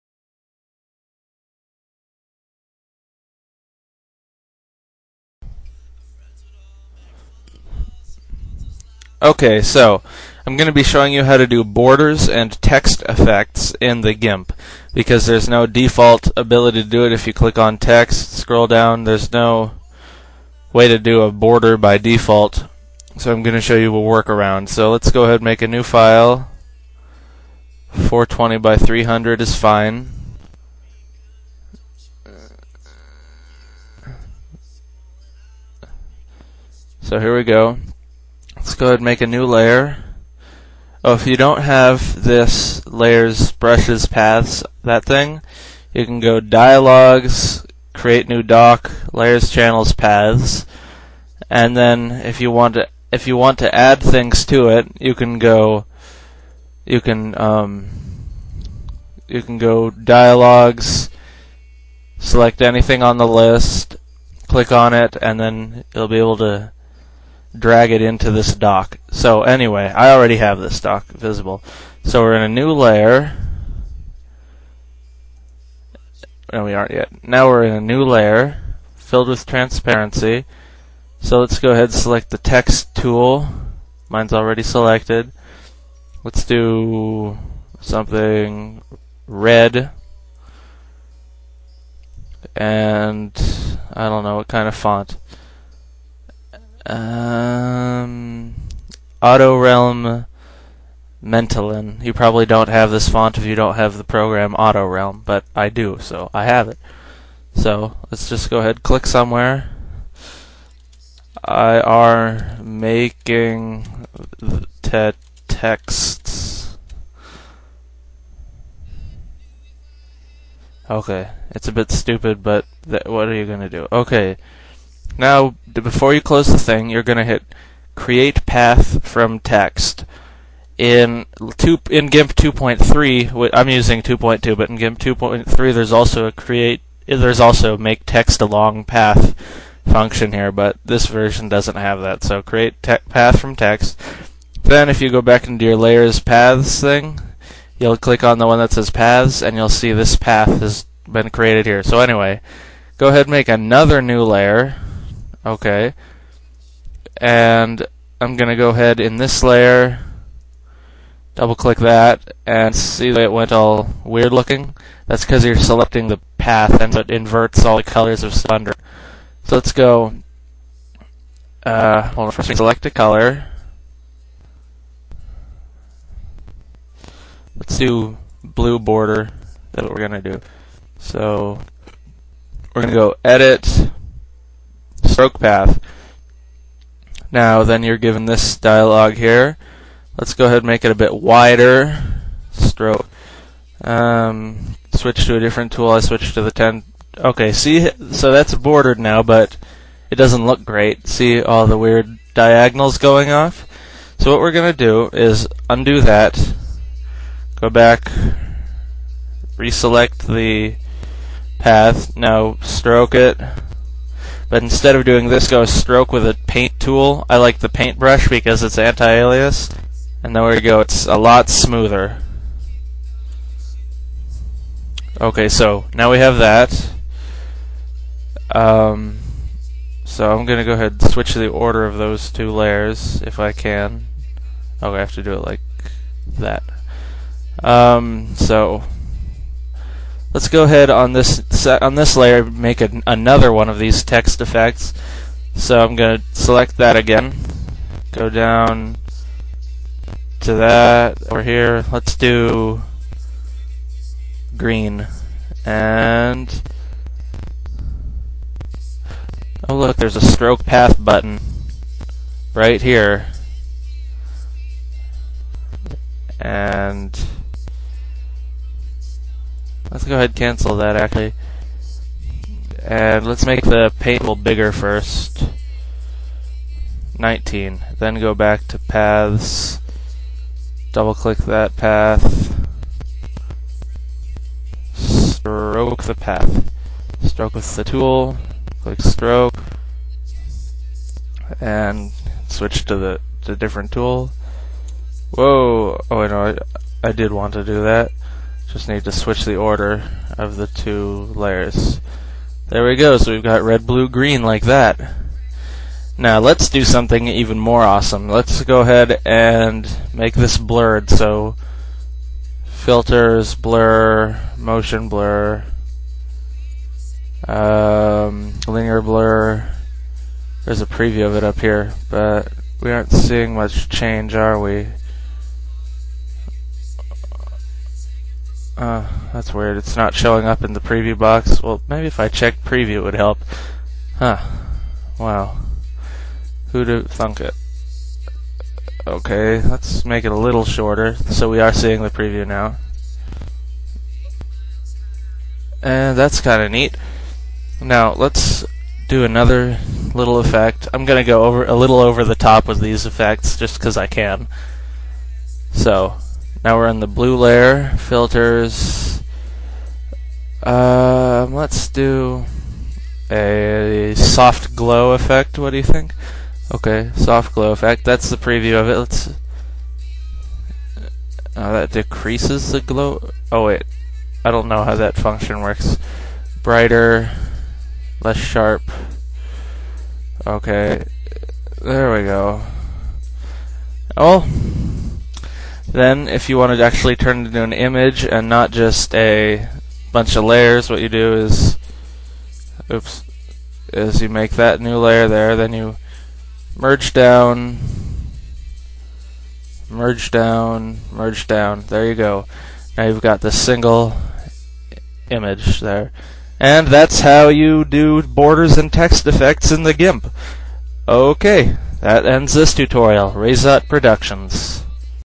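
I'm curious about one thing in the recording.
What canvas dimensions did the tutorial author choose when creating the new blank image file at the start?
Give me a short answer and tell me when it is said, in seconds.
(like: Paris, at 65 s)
420 by 300, at 27 s.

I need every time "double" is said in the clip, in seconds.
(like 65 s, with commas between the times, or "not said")
161 s, 280 s.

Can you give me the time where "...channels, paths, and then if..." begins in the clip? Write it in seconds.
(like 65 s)
49 s.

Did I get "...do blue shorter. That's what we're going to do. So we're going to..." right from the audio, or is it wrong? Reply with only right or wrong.
wrong.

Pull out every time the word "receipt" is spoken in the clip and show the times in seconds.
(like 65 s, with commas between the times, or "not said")
not said.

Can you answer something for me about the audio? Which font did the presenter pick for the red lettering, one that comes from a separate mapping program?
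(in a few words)
Auto Realm Mentalin.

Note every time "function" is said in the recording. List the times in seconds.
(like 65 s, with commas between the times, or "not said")
139 s, 375 s.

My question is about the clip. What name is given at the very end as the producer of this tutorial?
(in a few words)
Raise Productions.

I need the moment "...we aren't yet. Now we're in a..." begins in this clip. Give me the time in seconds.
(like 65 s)
76 s.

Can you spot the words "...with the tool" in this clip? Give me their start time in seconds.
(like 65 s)
287 s.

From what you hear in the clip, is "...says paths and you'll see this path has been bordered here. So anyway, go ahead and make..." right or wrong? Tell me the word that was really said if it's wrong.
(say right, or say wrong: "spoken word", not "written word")
wrong: "created", not "bordered".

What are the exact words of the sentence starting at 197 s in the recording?
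Okay, see, so that's bordered now, but it doesn't look great.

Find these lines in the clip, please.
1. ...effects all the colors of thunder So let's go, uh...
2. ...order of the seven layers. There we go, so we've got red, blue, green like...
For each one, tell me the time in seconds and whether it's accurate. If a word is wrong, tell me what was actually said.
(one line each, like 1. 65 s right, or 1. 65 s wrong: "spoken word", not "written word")
1. 167 s wrong: "inverts", not "effects"
2. 299 s wrong: "two", not "seven".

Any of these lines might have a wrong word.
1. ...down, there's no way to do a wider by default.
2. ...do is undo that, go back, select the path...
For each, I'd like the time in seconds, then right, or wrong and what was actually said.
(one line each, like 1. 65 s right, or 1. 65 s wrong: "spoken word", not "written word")
1. 18 s wrong: "border", not "wider"
2. 204 s wrong: "reselect", not "select".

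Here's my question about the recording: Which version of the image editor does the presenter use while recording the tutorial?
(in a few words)
2.2.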